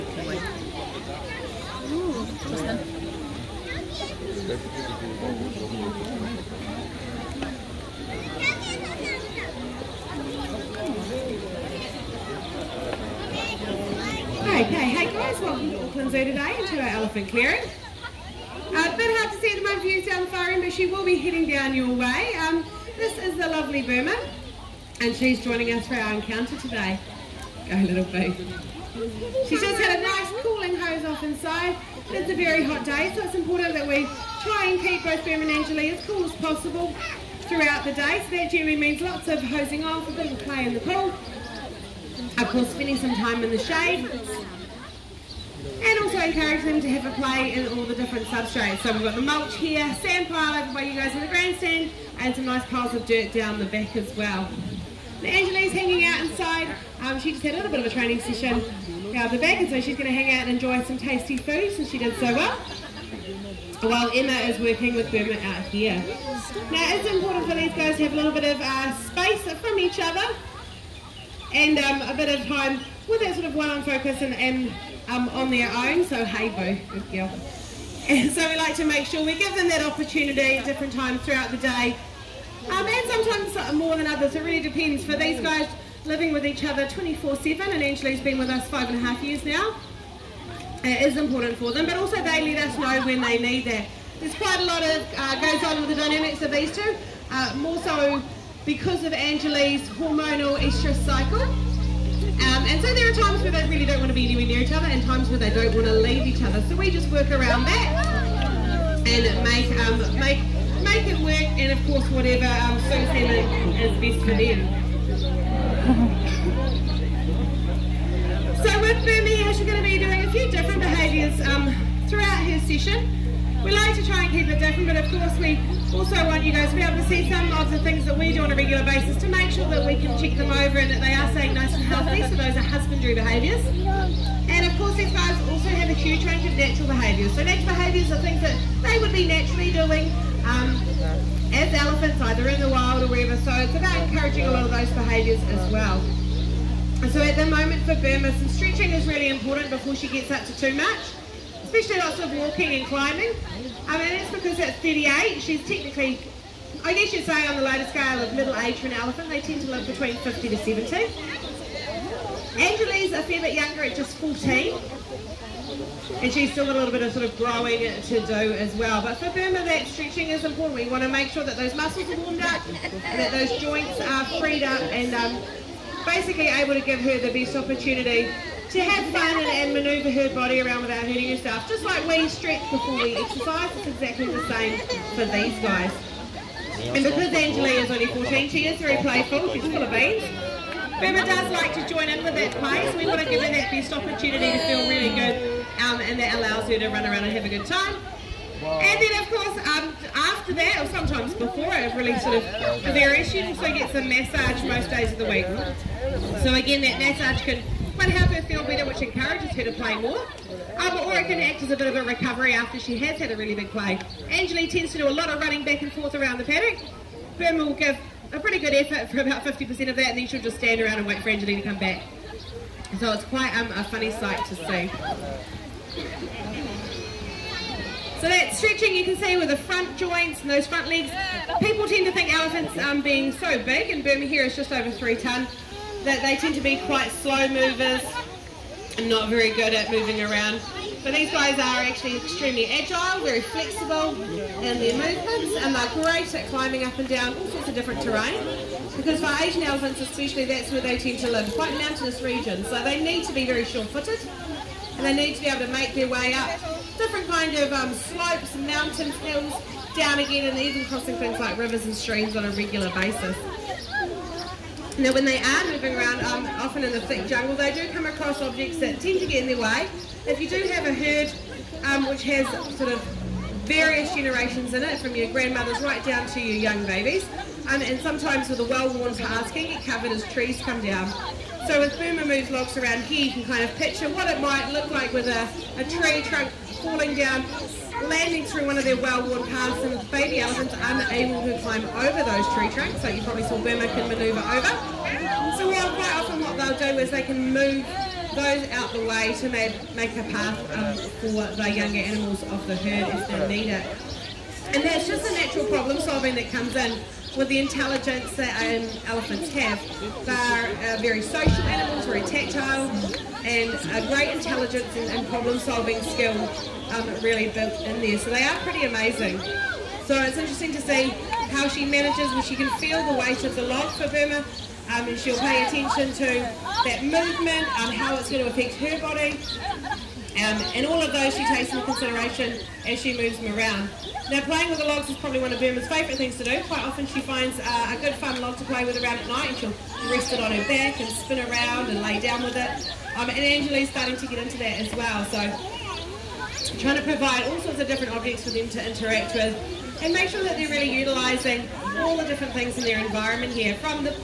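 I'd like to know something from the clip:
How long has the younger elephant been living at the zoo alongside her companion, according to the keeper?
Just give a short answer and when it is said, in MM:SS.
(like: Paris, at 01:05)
five and a half years, at 01:28.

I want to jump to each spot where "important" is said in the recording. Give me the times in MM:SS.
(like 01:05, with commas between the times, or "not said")
00:33, 01:07, 01:31, 02:29, 02:50.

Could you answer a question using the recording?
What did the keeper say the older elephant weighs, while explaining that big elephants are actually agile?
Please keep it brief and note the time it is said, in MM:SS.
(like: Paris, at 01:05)
just over 3 tonnes, at 03:54.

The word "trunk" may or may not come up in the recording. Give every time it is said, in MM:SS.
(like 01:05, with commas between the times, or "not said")
04:46, 04:52.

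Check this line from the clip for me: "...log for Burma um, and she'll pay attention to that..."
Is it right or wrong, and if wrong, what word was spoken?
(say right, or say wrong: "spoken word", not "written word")
right.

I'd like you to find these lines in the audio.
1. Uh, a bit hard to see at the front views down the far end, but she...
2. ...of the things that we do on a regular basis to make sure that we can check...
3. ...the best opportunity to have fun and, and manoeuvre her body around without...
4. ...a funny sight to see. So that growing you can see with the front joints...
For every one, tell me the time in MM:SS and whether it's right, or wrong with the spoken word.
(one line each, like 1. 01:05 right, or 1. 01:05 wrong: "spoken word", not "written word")
1. 00:18 wrong: "moment", not "front"
2. 02:07 right
3. 02:57 right
4. 03:43 wrong: "stretching", not "growing".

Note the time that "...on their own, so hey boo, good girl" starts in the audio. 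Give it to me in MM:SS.
01:15.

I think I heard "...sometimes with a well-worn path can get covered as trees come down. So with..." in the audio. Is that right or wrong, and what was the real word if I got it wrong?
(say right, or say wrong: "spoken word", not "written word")
right.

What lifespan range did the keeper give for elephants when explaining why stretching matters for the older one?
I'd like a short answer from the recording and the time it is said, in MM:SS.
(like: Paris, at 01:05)
50 to 70, at 02:40.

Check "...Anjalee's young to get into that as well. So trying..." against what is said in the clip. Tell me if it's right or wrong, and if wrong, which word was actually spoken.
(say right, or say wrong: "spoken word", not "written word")
wrong: "starting", not "young".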